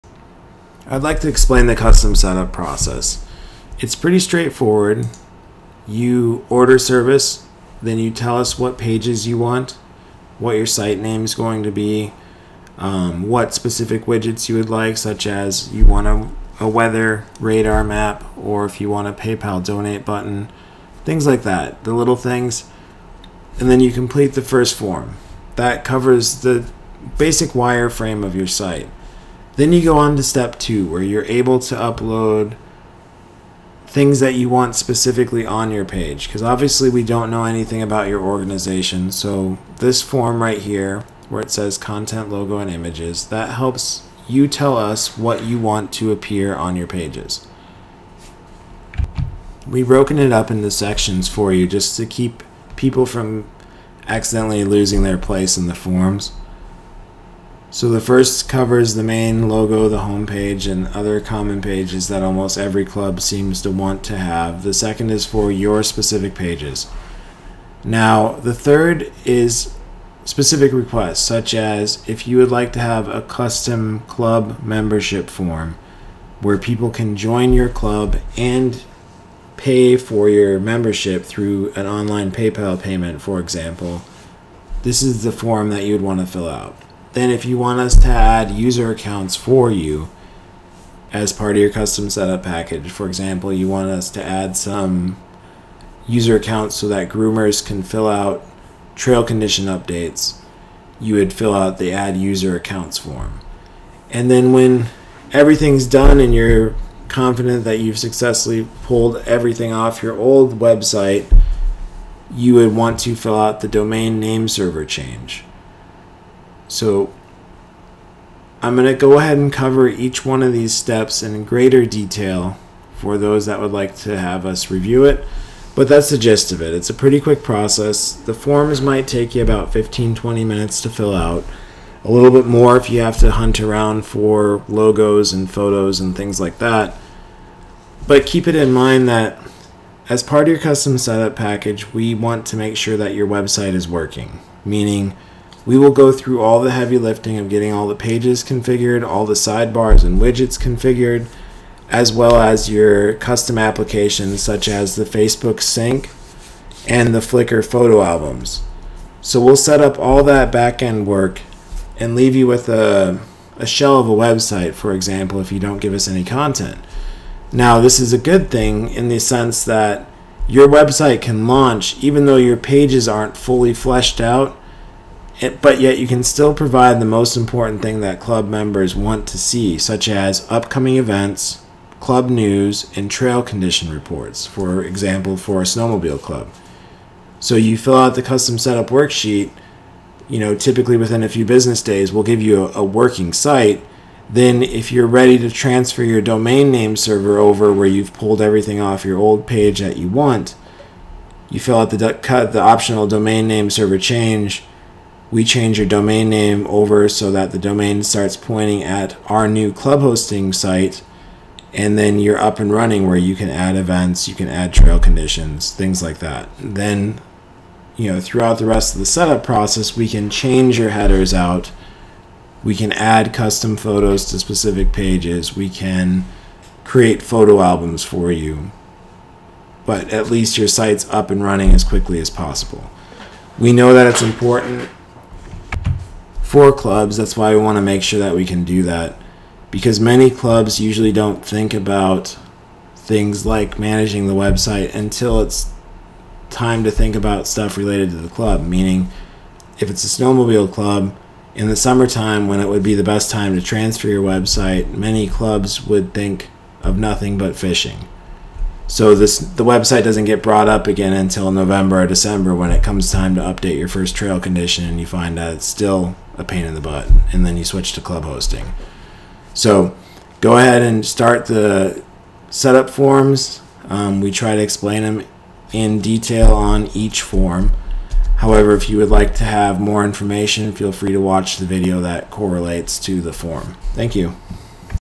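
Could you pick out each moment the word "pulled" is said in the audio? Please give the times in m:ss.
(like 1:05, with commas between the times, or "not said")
1:48, 3:18.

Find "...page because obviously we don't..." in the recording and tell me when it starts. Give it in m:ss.
0:35.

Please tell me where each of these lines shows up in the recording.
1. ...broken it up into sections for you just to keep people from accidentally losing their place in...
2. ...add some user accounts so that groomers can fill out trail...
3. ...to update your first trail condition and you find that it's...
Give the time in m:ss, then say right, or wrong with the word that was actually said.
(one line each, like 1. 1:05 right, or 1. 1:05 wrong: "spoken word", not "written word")
1. 0:49 right
2. 1:34 right
3. 4:23 right.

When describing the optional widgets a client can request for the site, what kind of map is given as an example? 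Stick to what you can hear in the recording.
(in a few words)
Weather radar map.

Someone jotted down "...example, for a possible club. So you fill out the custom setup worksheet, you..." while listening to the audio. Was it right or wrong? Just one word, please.
wrong.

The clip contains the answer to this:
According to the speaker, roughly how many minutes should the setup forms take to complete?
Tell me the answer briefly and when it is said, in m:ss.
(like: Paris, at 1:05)
15-20 minutes, at 2:09.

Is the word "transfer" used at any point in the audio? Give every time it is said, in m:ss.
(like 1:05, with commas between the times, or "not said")
3:15, 4:13.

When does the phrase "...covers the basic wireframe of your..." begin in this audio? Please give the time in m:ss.
0:25.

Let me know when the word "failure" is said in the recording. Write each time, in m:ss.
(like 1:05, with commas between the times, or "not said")
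not said.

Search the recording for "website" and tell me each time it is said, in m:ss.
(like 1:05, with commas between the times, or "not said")
1:50, 2:23, 2:44, 2:50, 4:04, 4:14, 4:19.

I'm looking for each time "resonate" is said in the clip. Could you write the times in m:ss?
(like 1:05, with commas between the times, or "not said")
not said.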